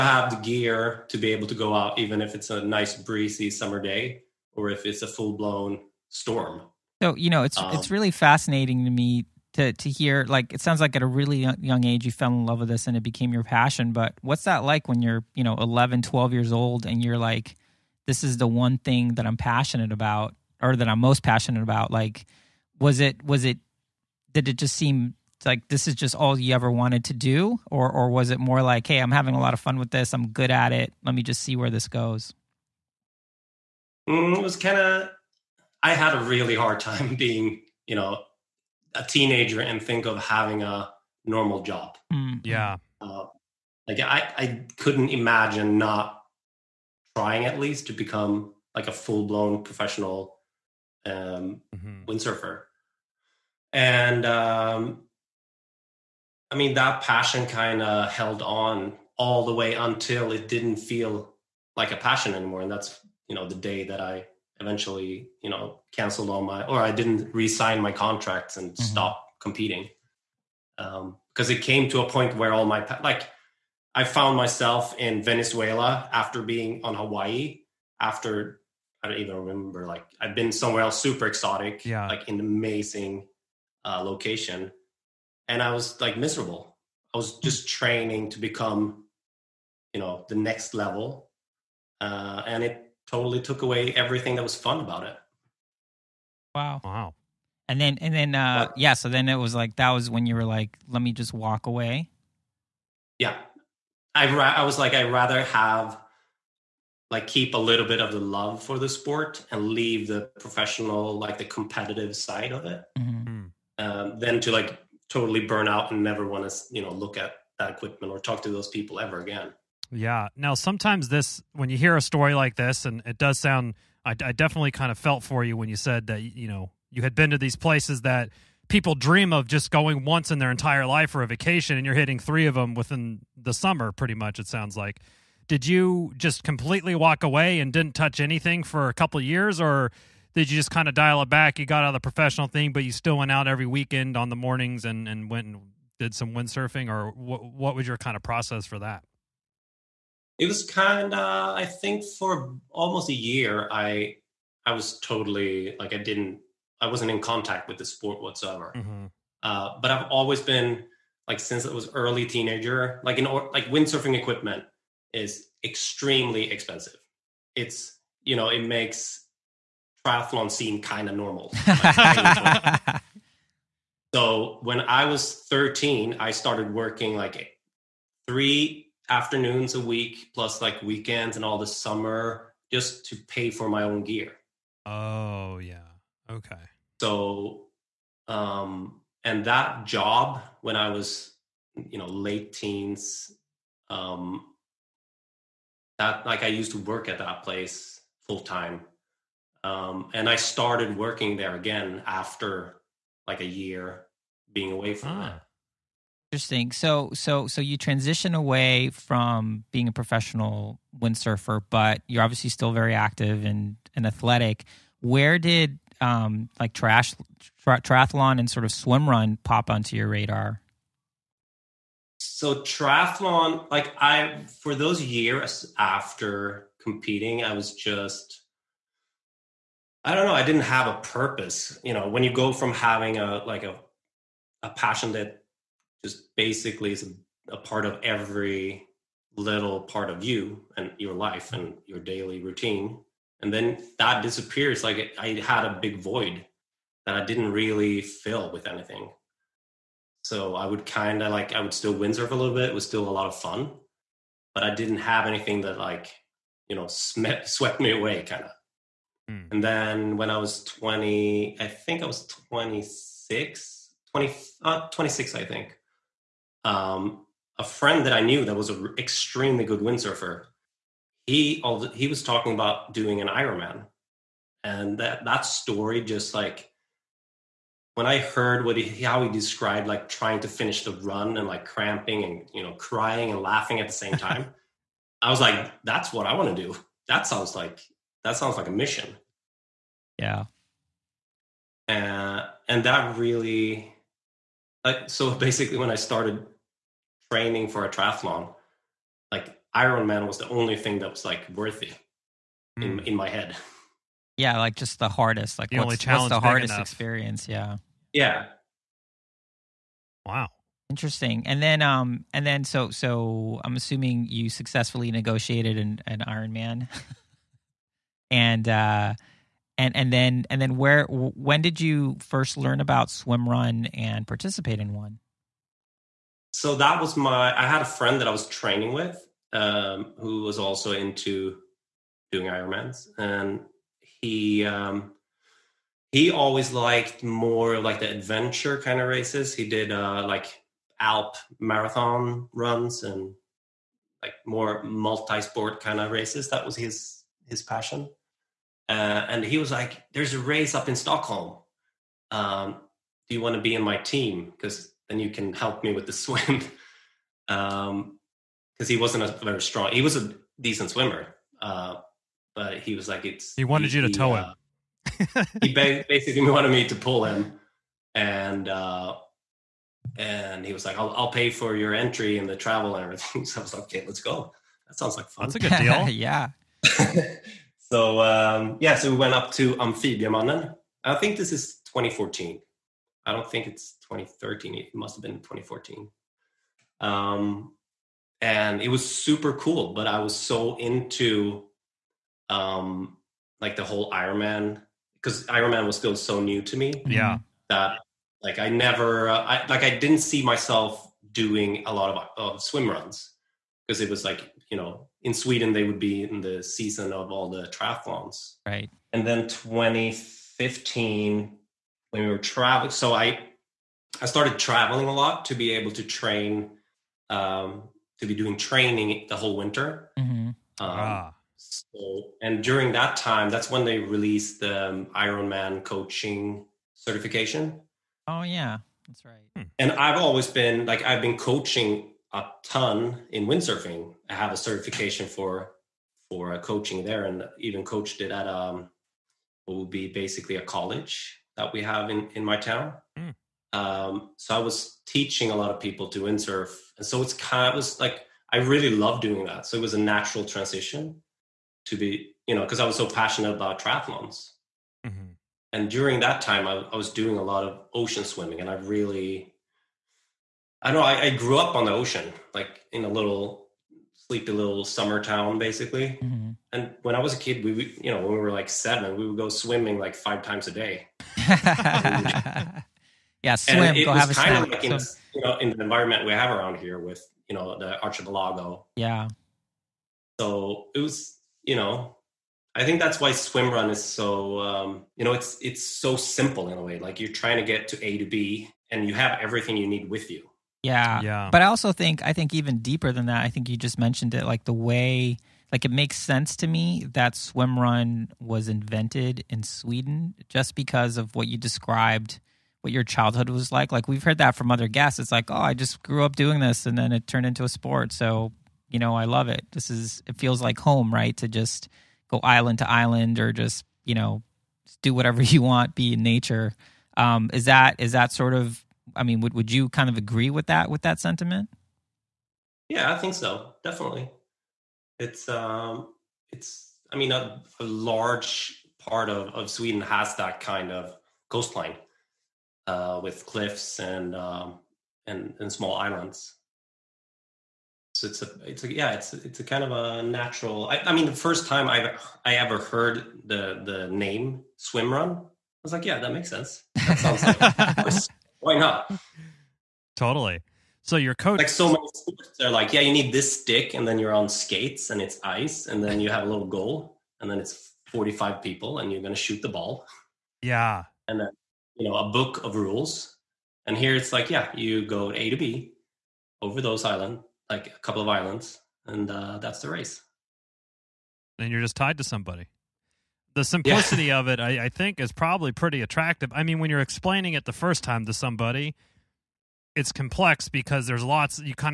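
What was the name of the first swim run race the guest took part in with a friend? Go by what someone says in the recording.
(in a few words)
Amphibiamannen.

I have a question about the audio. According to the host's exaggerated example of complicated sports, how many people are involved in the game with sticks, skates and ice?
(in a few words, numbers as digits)
45.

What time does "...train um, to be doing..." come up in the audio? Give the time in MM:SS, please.
06:56.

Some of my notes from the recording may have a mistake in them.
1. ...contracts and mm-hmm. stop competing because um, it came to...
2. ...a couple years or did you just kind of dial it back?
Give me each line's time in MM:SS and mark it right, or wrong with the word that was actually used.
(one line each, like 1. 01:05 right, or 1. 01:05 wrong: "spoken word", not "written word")
1. 01:07 right
2. 02:18 right.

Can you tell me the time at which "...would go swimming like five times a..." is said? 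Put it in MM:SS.
07:49.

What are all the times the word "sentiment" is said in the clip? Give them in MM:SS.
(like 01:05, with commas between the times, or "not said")
08:41.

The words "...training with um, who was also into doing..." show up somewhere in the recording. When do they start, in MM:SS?
05:28.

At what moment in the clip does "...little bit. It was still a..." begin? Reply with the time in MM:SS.
04:12.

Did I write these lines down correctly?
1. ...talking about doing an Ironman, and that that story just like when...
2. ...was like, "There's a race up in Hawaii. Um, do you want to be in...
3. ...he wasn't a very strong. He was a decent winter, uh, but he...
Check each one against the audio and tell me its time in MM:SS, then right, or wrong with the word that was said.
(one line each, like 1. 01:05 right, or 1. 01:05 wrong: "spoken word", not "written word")
1. 04:32 right
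2. 05:49 wrong: "Stockholm", not "Hawaii"
3. 05:58 wrong: "swimmer", not "winter".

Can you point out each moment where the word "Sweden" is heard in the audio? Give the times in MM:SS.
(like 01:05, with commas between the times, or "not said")
06:45, 08:19, 08:49.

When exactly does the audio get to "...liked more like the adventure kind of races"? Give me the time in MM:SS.
05:36.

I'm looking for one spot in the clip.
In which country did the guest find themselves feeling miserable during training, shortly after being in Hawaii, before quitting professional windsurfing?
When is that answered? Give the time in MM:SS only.
01:15.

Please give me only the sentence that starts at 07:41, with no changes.
I, I, grew up on the ocean, like in a little sleepy little summer town, basically.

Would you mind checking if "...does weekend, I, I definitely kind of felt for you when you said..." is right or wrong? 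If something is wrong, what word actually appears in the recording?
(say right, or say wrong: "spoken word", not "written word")
wrong: "sound", not "weekend".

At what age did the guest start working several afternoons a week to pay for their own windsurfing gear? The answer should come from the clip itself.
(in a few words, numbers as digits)
13.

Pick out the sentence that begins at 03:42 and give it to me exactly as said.
So triathlon, like I, for those years after competing, I was just I don't know.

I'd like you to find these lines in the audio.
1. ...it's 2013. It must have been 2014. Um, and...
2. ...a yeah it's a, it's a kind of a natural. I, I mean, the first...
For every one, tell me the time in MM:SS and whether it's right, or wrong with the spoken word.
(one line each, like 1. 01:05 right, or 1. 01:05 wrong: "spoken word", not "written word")
1. 06:23 right
2. 08:58 right.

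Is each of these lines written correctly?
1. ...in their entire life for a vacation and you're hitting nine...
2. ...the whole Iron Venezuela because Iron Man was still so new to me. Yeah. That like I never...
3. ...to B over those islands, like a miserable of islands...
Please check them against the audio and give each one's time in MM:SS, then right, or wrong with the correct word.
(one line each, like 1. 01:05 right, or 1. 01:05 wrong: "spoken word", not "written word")
1. 02:10 wrong: "three", not "nine"
2. 06:33 wrong: "Man", not "Venezuela"
3. 09:25 wrong: "couple", not "miserable".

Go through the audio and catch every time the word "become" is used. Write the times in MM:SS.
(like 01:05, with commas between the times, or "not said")
00:47, 01:28.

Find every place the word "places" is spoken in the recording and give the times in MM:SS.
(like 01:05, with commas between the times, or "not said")
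02:07, 03:17.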